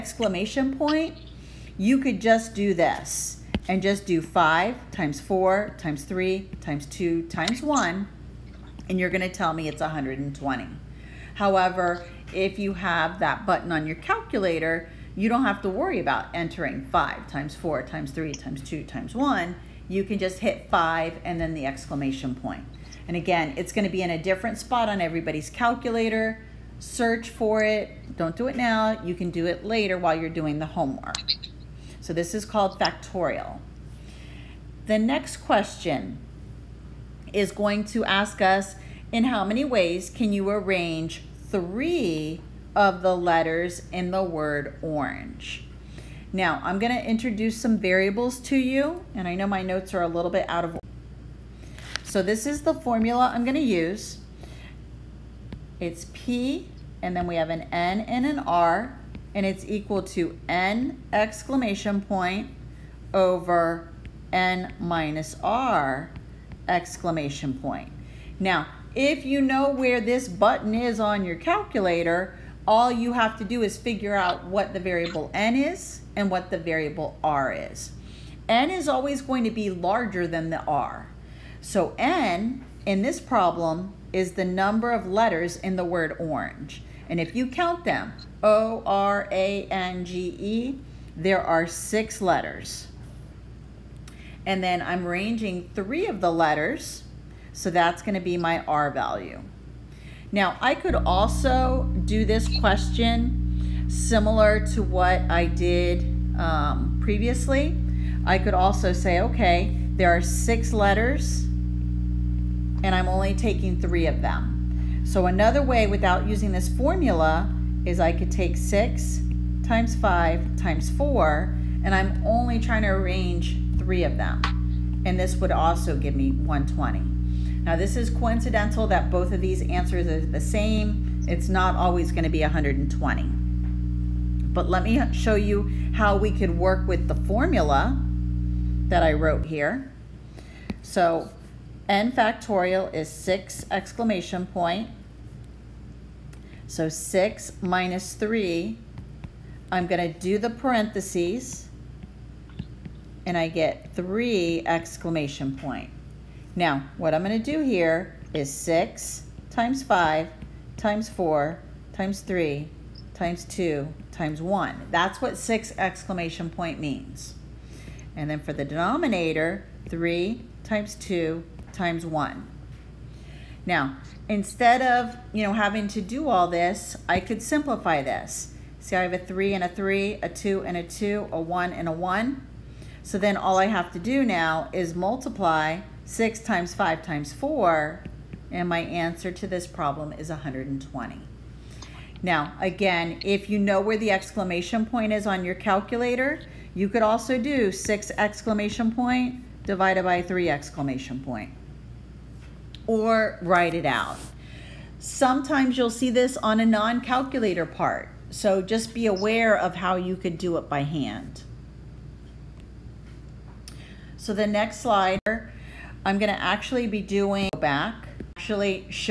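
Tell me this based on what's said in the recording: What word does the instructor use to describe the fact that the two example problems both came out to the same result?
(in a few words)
coincidental.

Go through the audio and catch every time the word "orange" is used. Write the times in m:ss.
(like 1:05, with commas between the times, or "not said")
0:44, 1:26.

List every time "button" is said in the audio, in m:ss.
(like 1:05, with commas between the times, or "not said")
0:13, 1:10.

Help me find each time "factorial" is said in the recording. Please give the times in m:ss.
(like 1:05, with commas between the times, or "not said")
0:32, 2:22.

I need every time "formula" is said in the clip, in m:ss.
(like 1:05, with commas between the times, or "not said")
0:52, 1:56, 2:17.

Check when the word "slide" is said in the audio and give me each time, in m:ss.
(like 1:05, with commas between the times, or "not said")
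3:34.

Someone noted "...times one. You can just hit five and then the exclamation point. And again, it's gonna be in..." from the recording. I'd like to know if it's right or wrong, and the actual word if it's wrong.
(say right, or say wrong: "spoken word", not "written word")
right.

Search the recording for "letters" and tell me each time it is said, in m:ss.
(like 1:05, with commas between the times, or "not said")
0:43, 1:25, 1:32, 1:36, 1:50.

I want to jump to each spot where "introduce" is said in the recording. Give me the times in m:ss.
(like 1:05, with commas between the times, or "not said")
0:47.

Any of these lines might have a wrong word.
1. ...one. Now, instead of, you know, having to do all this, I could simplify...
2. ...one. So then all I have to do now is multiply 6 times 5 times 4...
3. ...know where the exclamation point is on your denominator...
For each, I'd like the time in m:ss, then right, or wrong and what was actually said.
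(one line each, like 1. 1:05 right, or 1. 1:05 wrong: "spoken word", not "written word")
1. 2:52 right
2. 3:01 right
3. 3:13 wrong: "calculator", not "denominator".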